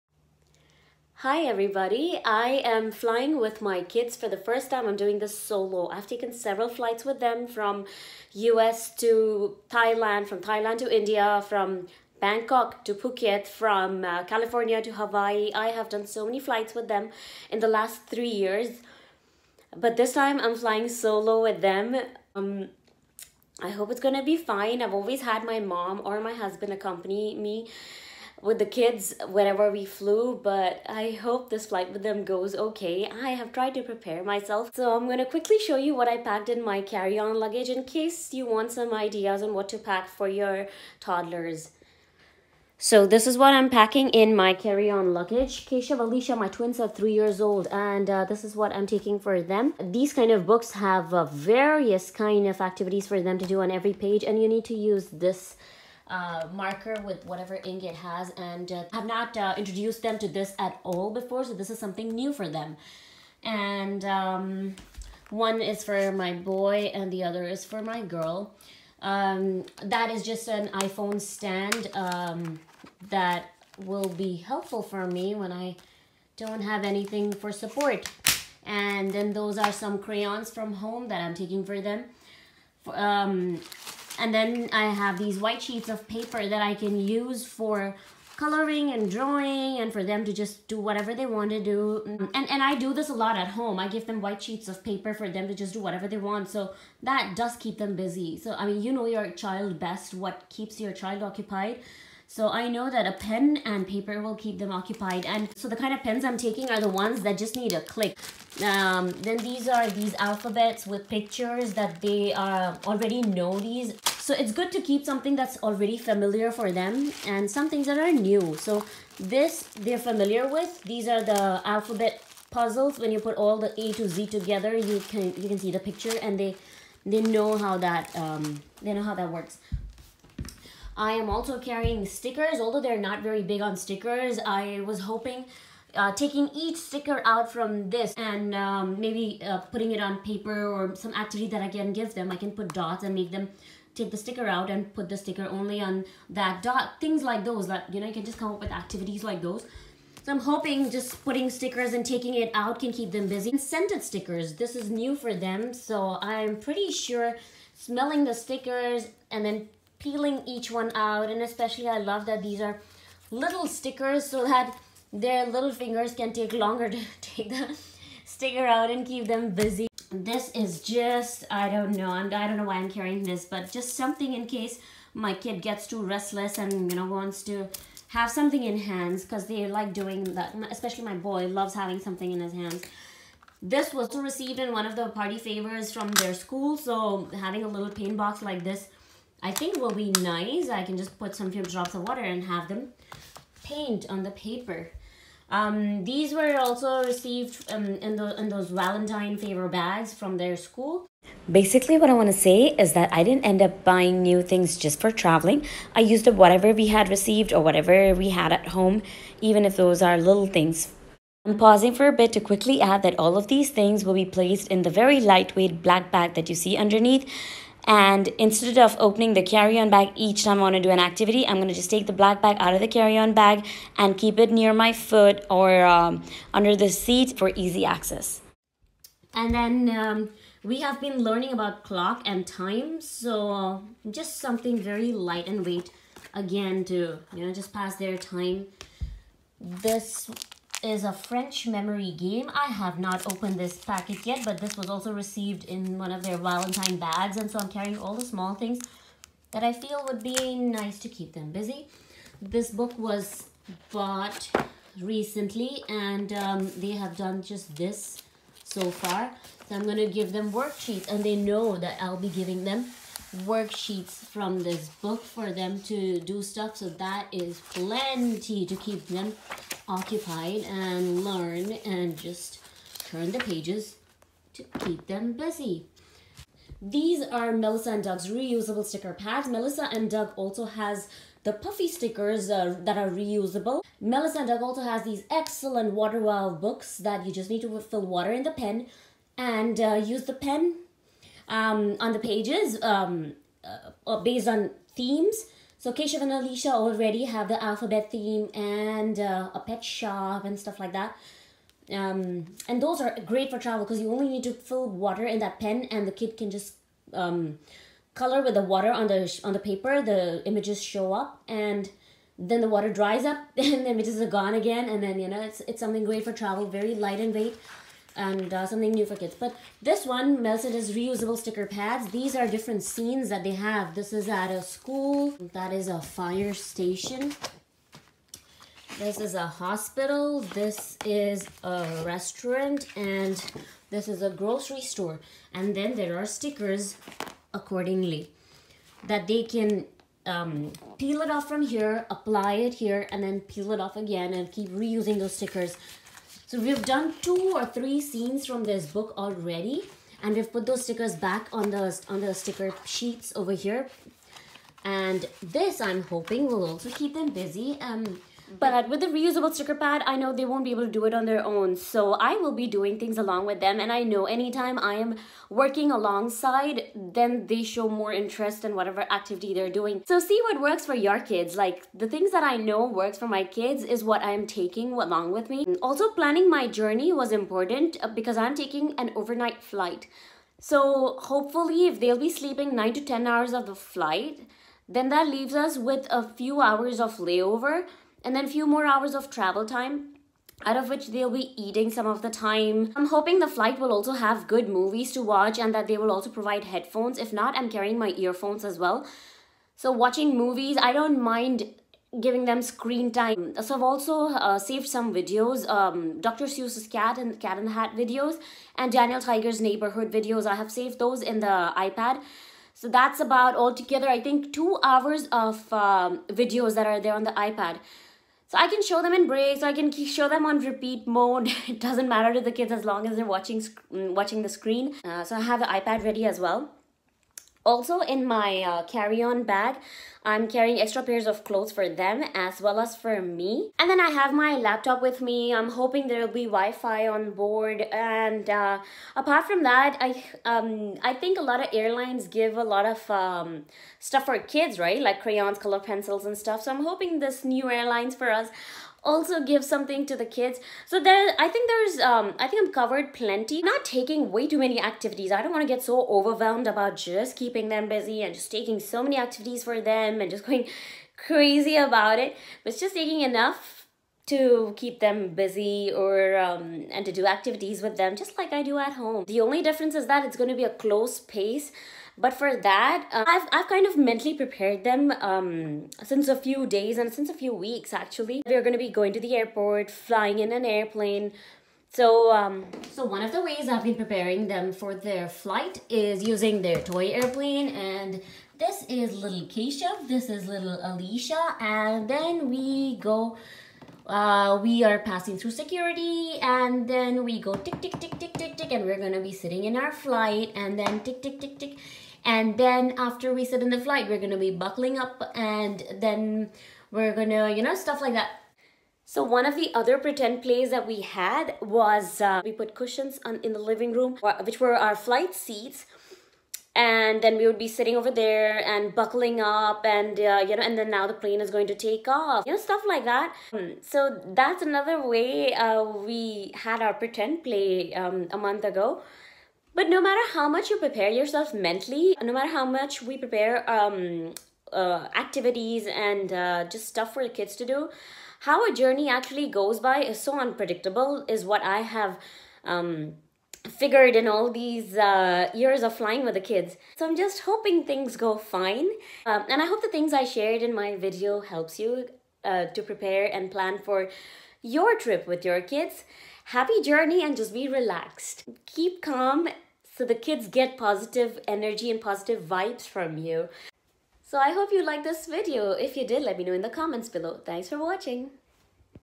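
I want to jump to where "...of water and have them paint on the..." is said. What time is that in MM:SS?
03:11.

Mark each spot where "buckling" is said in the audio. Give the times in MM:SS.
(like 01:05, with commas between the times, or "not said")
08:24, 08:38.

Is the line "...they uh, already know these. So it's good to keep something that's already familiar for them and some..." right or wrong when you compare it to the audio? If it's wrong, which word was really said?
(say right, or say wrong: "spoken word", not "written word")
right.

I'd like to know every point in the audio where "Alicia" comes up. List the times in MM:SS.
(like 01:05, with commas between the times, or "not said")
00:45, 04:56, 08:10.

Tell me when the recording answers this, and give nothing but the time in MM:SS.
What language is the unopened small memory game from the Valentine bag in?
04:01.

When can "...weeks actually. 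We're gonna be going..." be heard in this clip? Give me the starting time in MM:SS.
07:57.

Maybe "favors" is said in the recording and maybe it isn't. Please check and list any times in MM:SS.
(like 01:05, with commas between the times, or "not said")
03:05, 03:19.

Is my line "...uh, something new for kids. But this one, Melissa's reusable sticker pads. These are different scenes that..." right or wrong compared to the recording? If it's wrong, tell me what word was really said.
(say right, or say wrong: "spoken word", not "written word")
right.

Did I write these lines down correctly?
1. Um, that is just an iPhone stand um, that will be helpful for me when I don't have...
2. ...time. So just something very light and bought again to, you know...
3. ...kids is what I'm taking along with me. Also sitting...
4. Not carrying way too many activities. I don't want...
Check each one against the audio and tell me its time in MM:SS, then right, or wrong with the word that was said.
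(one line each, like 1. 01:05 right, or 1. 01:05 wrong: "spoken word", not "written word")
1. 01:09 right
2. 03:52 wrong: "weight", not "bought"
3. 06:13 wrong: "planning", not "sitting"
4. 07:33 wrong: "taking", not "carrying".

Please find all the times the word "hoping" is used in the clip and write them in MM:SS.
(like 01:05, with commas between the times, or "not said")
02:15, 02:30, 05:56, 06:33, 07:15, 07:26, 09:07.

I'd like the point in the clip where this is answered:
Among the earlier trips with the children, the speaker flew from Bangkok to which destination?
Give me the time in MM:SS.
00:12.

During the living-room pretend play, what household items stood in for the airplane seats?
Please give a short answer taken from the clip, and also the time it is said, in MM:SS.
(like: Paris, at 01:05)
Cushions, at 08:32.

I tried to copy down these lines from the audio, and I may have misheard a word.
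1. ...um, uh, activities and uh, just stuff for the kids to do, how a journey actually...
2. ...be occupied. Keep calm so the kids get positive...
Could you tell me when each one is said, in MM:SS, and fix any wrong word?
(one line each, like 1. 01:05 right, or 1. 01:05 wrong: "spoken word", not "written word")
1. 08:53 right
2. 09:17 wrong: "relaxed", not "occupied".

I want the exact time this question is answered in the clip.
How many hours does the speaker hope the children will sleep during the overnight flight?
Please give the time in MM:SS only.
06:22.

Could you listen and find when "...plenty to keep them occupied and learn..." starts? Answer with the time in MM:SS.
04:27.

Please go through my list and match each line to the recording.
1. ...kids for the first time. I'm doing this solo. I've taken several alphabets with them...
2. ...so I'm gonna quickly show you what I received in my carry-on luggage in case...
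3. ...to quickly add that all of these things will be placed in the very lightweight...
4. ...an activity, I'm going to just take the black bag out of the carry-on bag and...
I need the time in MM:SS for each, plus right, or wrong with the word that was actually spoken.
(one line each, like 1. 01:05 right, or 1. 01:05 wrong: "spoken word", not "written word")
1. 00:03 wrong: "flights", not "alphabets"
2. 00:34 wrong: "packed", not "received"
3. 03:32 right
4. 03:40 right.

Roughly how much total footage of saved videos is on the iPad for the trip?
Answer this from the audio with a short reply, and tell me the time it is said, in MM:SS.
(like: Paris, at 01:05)
2 hours, at 06:54.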